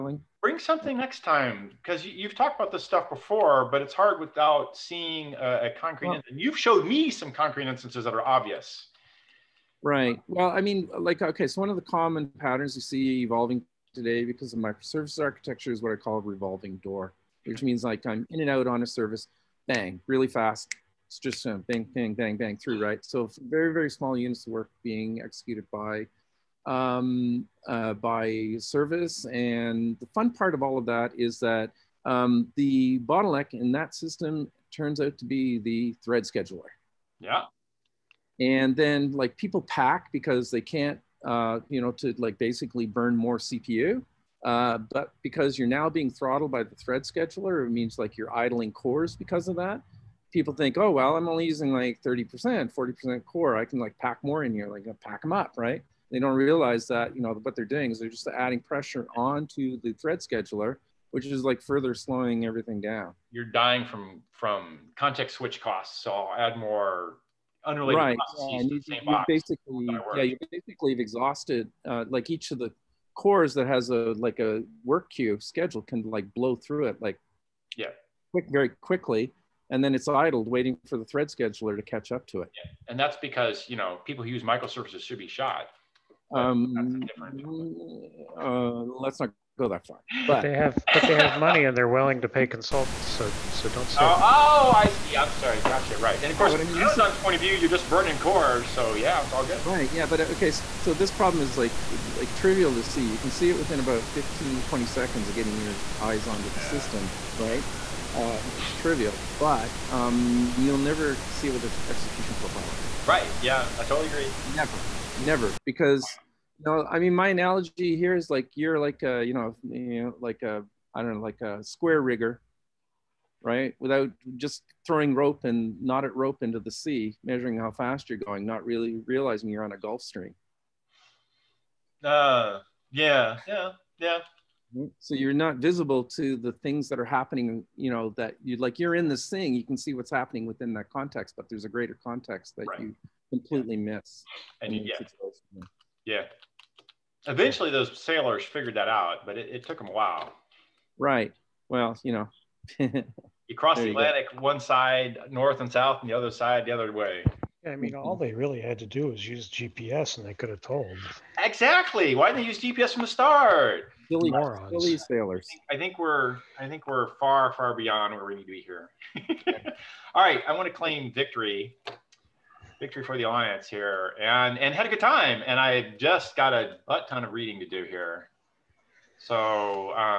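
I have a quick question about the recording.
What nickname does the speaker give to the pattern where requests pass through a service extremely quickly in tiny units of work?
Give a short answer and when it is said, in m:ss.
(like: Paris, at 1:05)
revolving door, at 0:16.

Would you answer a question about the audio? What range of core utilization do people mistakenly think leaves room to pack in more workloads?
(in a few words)
30% to 40%.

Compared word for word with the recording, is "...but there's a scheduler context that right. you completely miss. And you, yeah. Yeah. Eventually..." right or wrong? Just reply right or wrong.
wrong.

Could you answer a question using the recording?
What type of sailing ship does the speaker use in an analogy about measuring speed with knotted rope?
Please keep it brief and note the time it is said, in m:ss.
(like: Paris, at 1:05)
square rigger, at 2:01.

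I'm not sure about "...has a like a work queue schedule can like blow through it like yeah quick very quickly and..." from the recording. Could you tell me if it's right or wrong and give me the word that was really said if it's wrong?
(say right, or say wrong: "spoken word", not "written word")
right.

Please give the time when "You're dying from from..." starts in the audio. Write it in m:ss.
1:03.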